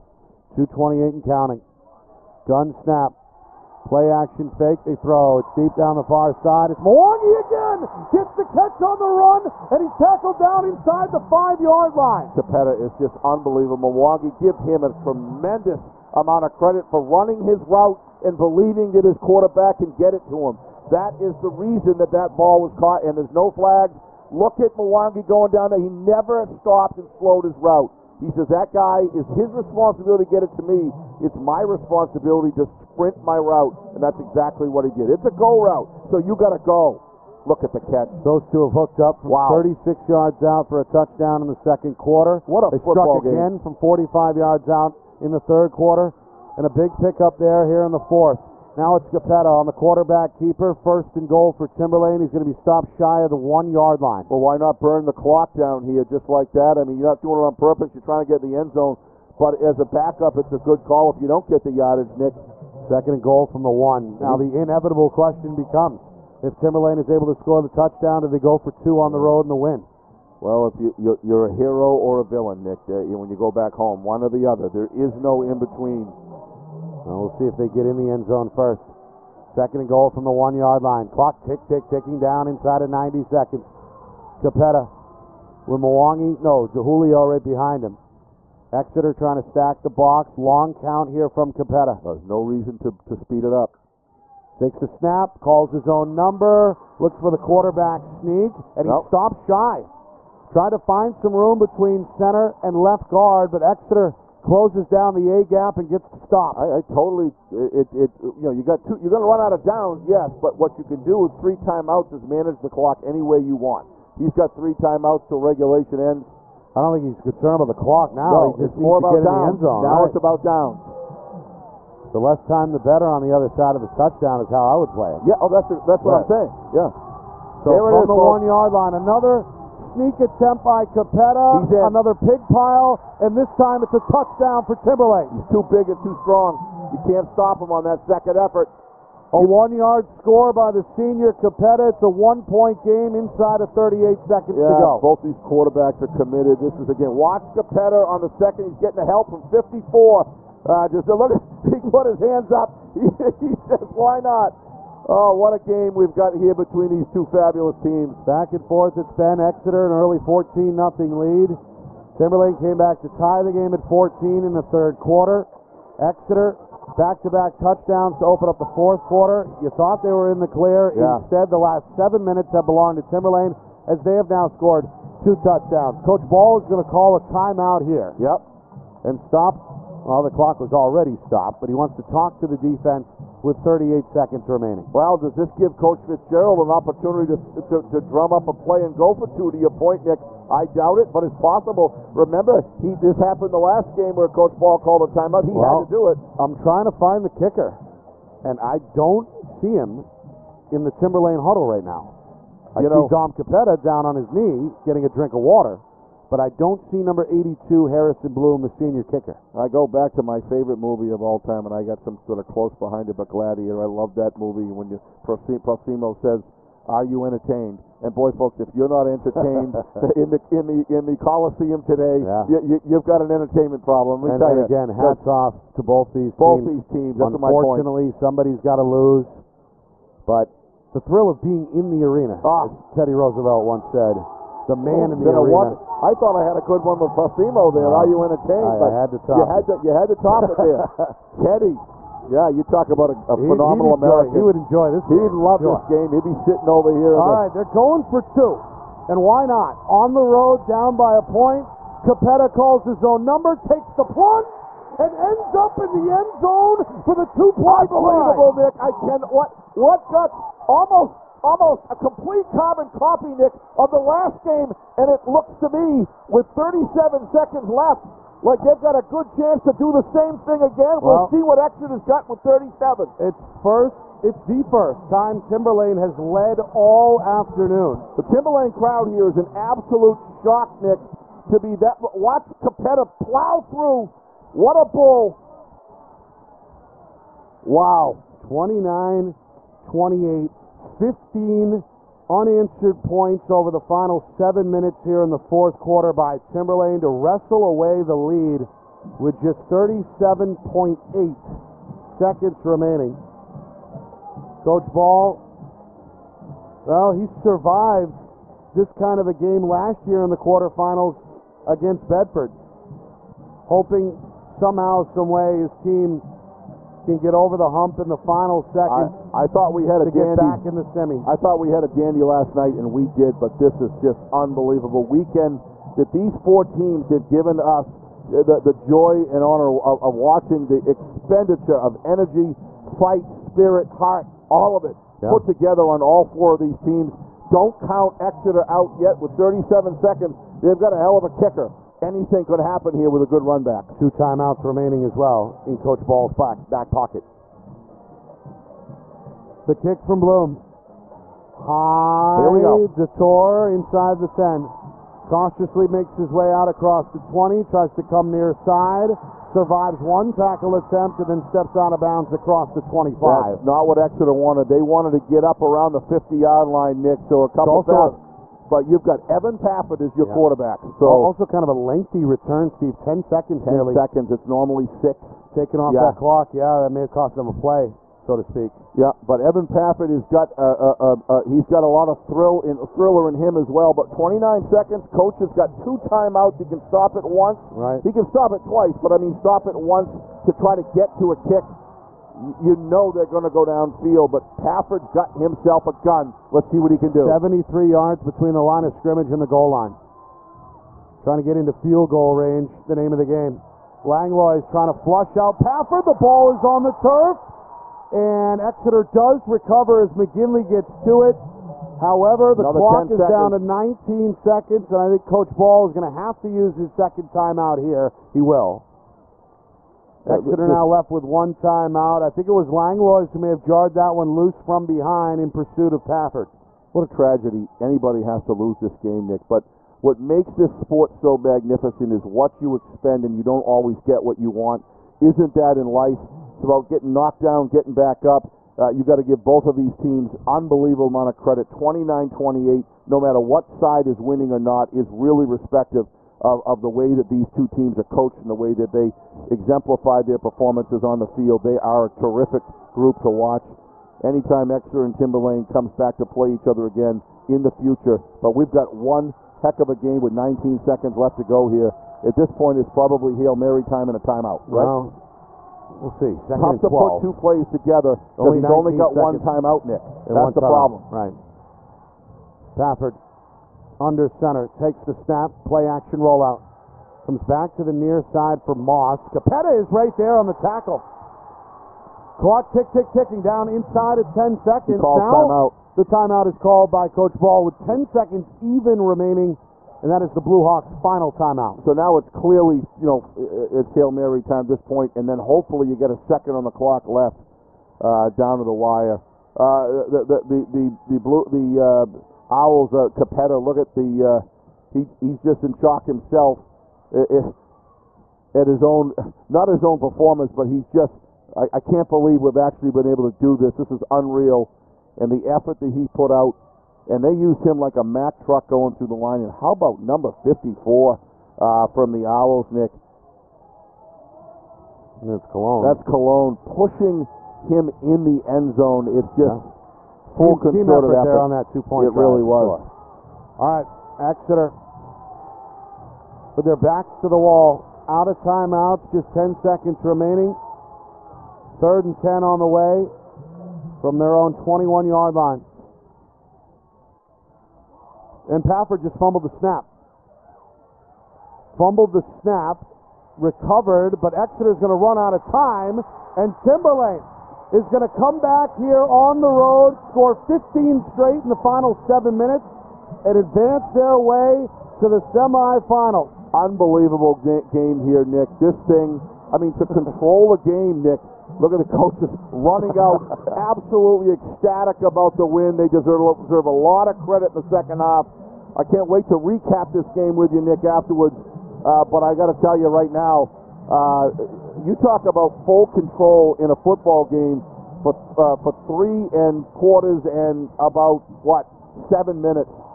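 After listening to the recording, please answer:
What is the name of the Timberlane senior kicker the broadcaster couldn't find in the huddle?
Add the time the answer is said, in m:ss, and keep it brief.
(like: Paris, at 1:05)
Harrison Bloom, at 3:27.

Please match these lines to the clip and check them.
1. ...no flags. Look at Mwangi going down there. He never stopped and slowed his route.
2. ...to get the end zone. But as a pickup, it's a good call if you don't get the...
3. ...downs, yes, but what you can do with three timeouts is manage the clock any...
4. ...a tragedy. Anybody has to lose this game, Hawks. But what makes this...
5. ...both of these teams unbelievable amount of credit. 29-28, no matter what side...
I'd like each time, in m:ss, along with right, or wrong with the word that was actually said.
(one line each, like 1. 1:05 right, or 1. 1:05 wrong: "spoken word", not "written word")
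1. 0:23 right
2. 0:58 wrong: "backup", not "pickup"
3. 1:49 right
4. 7:07 wrong: "Nick", not "Hawks"
5. 7:19 right.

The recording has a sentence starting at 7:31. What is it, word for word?
They are a terrific group to watch.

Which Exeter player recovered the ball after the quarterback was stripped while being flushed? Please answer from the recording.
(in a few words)
McGinley.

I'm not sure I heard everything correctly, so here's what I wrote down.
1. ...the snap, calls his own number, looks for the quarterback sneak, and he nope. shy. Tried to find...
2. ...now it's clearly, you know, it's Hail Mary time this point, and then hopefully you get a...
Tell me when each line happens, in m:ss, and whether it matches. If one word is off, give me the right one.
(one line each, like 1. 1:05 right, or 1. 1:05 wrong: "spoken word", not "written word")
1. 1:34 right
2. 8:11 right.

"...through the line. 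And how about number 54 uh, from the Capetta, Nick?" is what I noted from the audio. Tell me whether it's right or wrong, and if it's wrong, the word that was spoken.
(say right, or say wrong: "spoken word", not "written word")
wrong: "Owls", not "Capetta".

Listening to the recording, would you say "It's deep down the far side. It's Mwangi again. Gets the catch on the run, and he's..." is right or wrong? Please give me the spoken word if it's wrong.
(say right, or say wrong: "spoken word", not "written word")
right.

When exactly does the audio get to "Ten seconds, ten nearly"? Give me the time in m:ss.
6:12.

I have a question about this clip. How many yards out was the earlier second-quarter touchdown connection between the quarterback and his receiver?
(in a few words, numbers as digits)
36.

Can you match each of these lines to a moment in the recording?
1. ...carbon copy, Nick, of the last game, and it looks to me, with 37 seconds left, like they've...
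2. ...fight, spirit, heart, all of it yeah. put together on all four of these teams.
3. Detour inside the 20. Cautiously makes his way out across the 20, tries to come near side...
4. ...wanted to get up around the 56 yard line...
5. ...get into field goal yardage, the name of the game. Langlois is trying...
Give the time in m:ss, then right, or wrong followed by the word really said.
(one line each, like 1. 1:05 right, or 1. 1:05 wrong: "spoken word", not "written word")
1. 4:22 right
2. 5:32 right
3. 5:52 wrong: "10", not "20"
4. 6:04 wrong: "50", not "56"
5. 6:41 wrong: "range", not "yardage".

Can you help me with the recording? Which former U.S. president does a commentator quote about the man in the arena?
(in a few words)
Teddy Roosevelt.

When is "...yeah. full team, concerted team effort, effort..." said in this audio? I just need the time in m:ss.
8:49.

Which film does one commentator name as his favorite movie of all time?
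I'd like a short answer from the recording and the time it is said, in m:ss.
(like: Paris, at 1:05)
Gladiator, at 3:33.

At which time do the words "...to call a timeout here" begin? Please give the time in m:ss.
2:56.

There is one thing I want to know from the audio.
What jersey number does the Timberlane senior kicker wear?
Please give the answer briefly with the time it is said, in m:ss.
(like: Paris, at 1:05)
82, at 3:27.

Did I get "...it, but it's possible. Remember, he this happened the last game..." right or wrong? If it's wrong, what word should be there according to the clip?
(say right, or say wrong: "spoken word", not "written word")
right.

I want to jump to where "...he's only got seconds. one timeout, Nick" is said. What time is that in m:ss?
7:48.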